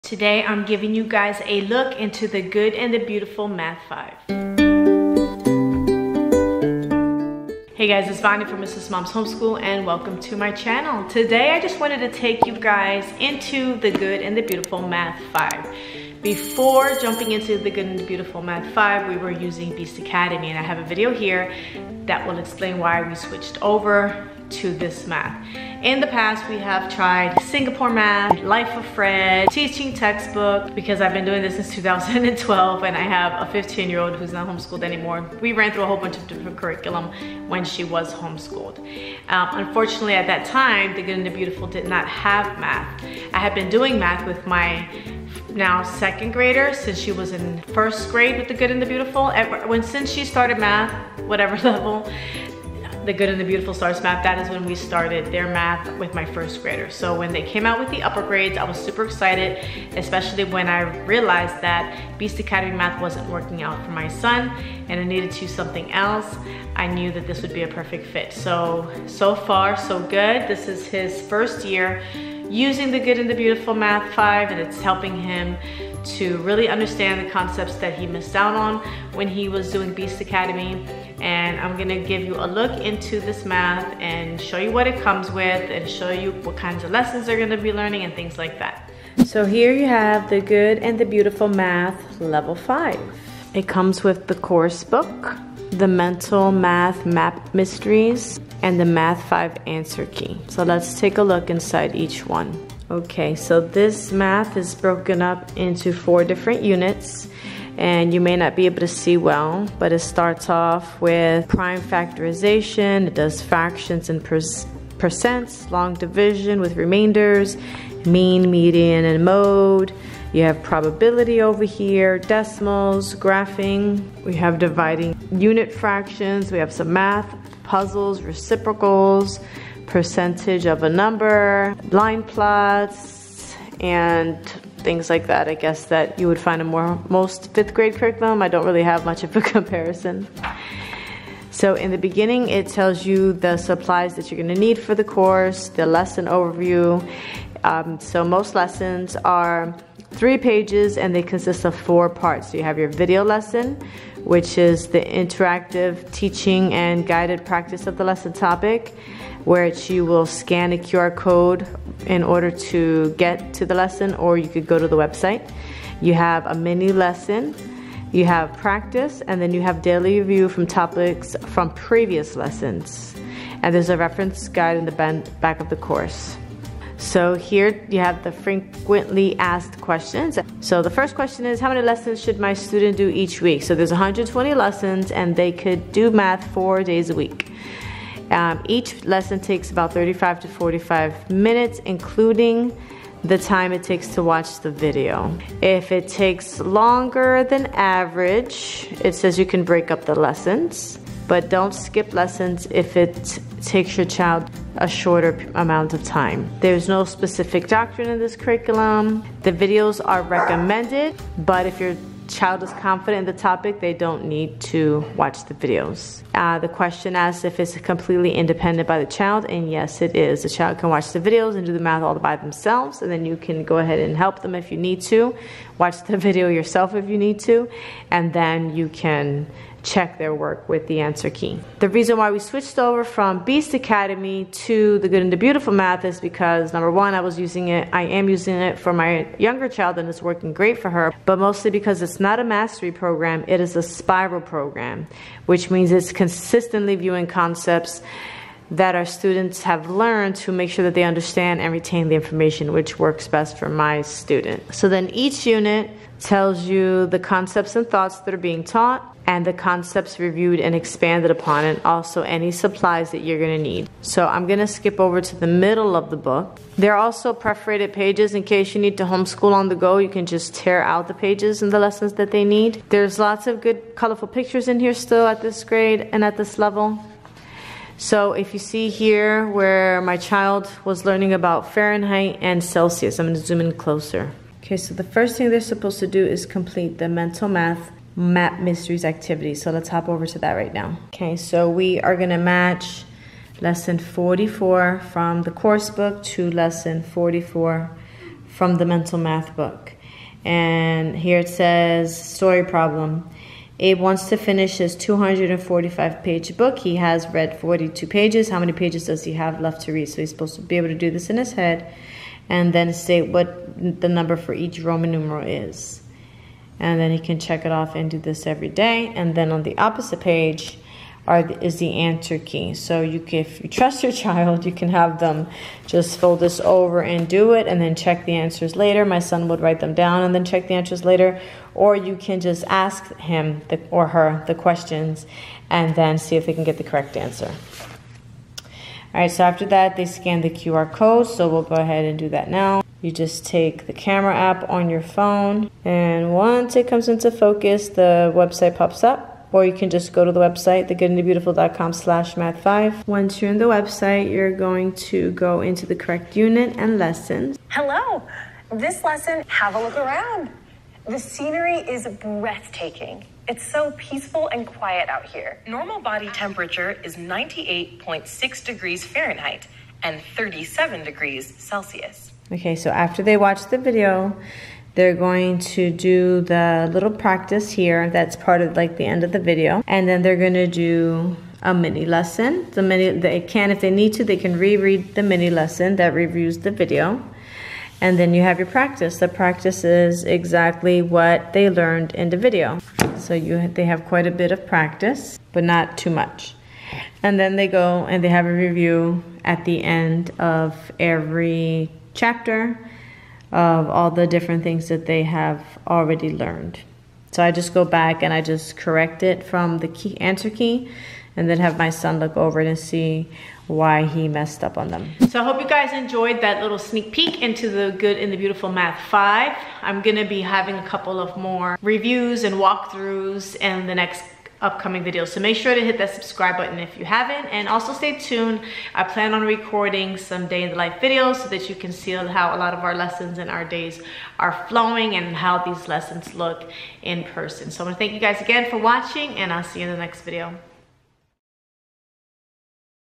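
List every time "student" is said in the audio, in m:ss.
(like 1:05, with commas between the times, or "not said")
3:02, 4:09, 4:14.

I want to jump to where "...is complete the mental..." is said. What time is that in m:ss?
4:46.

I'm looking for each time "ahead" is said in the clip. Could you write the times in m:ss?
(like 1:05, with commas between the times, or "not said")
3:43, 5:41.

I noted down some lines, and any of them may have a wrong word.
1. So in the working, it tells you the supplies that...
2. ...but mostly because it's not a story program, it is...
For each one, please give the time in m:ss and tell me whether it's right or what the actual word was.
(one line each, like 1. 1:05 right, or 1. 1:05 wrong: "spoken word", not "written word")
1. 2:21 wrong: "beginning", not "working"
2. 4:01 wrong: "mastery", not "story".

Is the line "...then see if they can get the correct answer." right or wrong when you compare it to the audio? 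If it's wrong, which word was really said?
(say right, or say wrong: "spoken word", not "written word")
right.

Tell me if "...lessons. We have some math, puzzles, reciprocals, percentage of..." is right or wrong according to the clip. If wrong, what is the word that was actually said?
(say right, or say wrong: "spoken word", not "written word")
wrong: "fractions", not "lessons".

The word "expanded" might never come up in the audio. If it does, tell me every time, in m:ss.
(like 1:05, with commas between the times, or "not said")
4:20.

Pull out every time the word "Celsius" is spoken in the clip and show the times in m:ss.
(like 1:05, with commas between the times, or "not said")
4:42, 6:11.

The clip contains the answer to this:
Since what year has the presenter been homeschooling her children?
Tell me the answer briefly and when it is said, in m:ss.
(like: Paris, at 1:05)
2012, at 0:31.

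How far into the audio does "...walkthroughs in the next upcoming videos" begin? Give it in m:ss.
7:02.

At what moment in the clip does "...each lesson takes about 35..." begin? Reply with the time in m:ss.
3:08.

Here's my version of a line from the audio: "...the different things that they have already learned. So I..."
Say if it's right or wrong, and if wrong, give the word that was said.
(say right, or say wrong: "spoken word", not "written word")
right.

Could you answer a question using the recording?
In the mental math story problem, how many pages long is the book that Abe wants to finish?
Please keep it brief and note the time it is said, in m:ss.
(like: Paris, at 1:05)
245, at 5:04.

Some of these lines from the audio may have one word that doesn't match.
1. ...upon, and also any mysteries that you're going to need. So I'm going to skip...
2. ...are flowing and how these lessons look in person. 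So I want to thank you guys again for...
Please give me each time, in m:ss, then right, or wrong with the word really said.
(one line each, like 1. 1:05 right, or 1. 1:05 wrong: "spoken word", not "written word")
1. 4:21 wrong: "supplies", not "mysteries"
2. 7:14 right.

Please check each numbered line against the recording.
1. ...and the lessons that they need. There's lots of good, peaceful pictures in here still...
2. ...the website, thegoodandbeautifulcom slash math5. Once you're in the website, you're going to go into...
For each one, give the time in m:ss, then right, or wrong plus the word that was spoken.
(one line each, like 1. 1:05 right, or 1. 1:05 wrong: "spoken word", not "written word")
1. 4:31 wrong: "colorful", not "peaceful"
2. 5:50 right.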